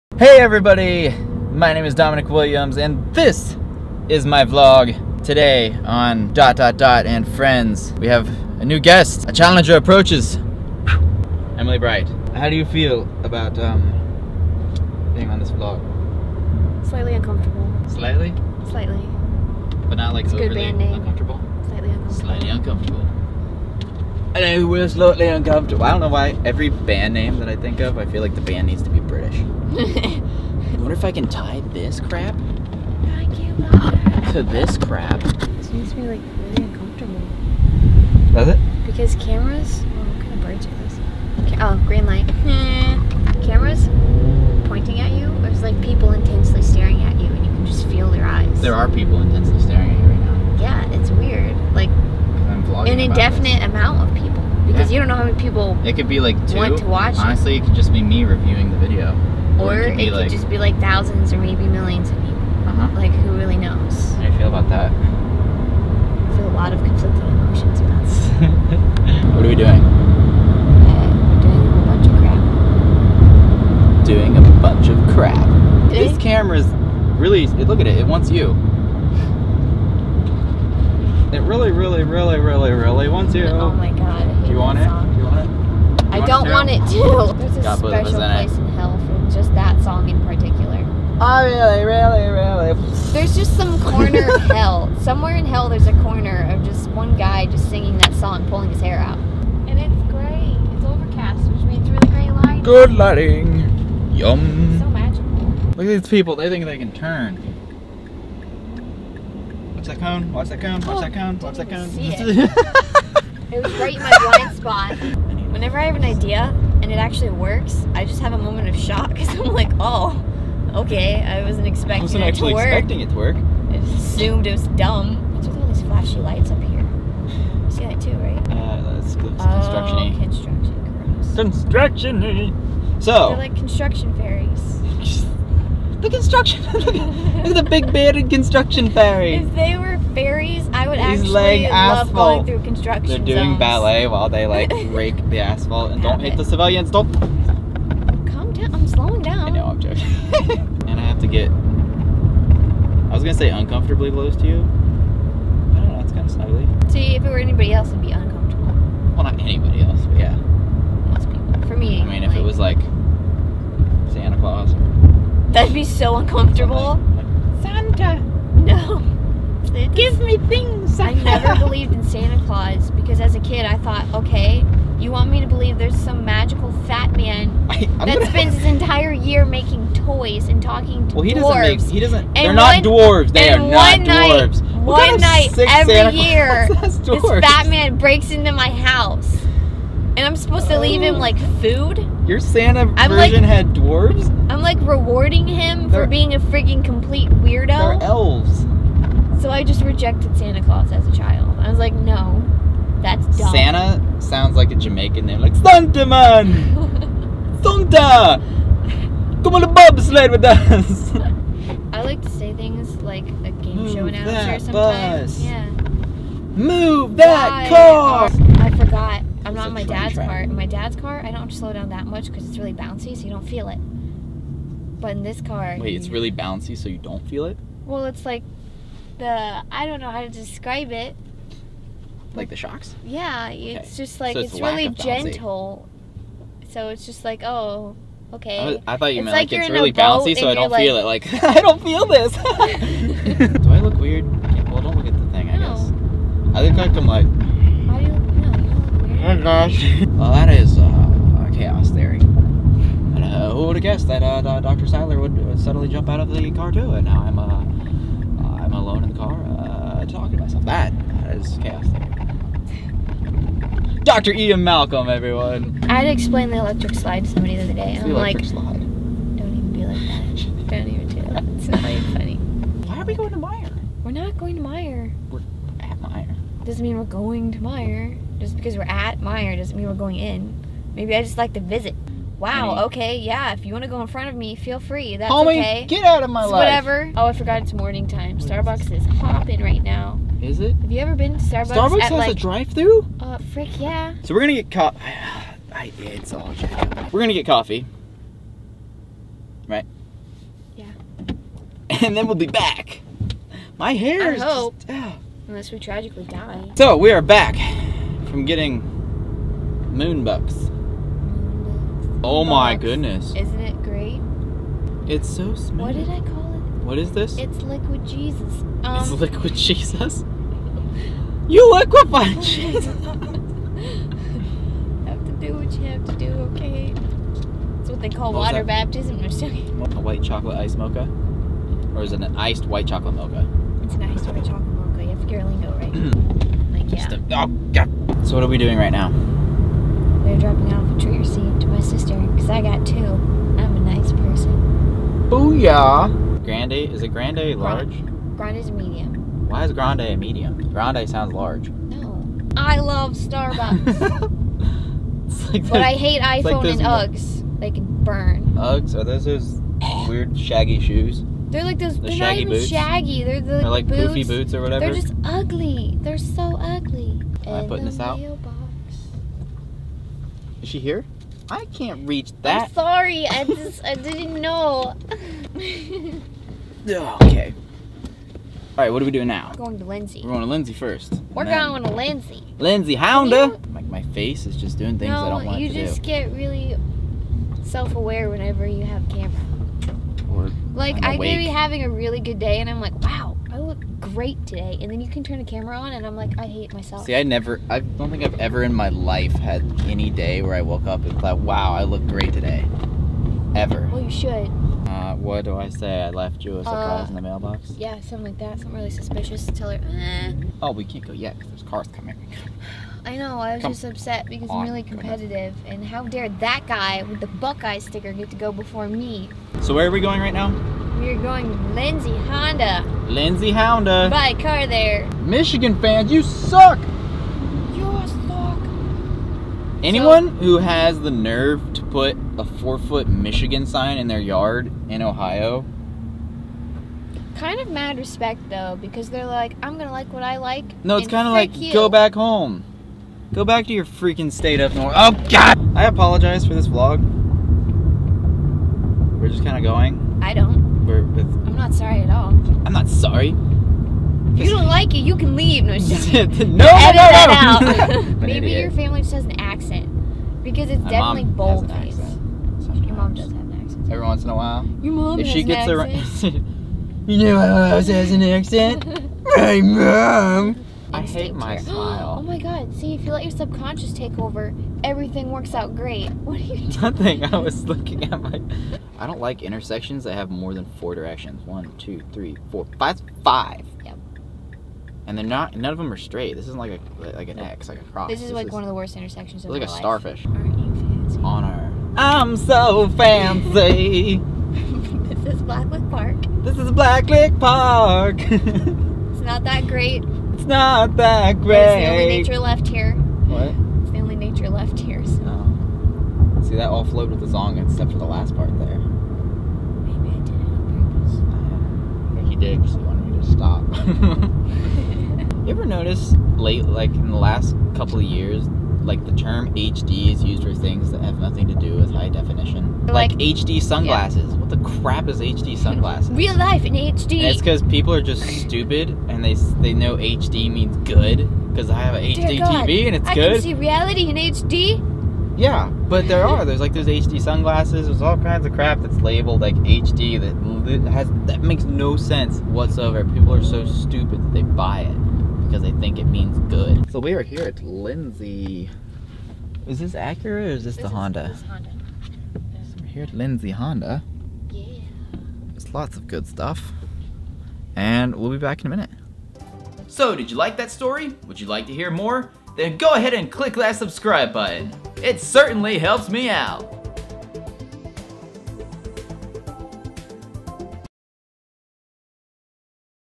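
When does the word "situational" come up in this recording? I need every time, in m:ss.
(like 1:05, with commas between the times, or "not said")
not said.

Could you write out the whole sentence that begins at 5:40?
We're dropping off a treat receipt to my sister because I got two.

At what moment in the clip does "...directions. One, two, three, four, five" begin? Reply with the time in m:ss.
8:00.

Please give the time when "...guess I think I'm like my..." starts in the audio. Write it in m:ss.
4:05.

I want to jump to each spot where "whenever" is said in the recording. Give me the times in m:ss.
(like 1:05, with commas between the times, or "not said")
1:55, 6:28.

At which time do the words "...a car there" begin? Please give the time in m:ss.
7:04.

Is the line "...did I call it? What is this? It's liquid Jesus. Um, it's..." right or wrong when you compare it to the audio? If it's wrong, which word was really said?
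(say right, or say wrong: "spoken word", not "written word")
right.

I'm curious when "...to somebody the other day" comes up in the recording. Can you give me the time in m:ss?
4:27.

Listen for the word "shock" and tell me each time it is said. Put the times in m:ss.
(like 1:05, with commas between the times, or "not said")
1:58, 3:52.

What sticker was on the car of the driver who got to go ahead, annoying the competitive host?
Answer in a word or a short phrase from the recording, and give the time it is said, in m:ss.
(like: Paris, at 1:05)
Buckeye sticker, at 6:57.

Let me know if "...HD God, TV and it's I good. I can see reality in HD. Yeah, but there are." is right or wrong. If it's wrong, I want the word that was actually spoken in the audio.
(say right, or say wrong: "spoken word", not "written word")
right.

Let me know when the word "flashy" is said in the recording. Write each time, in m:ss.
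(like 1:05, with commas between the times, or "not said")
2:05.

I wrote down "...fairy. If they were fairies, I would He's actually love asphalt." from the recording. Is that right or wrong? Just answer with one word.
right.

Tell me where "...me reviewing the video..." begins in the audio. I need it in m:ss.
0:58.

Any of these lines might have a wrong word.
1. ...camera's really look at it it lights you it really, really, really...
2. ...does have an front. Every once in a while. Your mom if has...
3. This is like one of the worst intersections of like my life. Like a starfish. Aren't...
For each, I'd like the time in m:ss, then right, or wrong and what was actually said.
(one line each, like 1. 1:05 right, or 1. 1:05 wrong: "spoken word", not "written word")
1. 1:16 wrong: "wants", not "lights"
2. 7:43 wrong: "accent", not "front"
3. 8:08 right.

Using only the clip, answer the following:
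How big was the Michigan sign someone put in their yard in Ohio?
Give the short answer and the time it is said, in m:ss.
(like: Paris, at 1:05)
four foot, at 7:12.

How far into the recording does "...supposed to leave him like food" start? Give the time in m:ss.
3:10.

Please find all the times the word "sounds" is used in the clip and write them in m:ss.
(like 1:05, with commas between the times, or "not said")
3:24, 5:51.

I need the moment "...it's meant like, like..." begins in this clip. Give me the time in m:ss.
3:59.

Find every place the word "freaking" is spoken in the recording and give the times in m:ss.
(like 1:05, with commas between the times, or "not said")
3:16, 7:23.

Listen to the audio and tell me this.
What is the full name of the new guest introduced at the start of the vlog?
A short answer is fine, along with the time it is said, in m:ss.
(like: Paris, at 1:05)
Emily Bright, at 0:11.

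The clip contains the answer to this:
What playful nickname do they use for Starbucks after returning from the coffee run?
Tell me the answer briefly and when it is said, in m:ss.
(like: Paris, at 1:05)
moon bucks, at 5:09.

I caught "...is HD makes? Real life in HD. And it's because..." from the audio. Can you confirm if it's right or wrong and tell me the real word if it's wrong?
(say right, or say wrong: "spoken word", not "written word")
wrong: "sunglasses", not "makes".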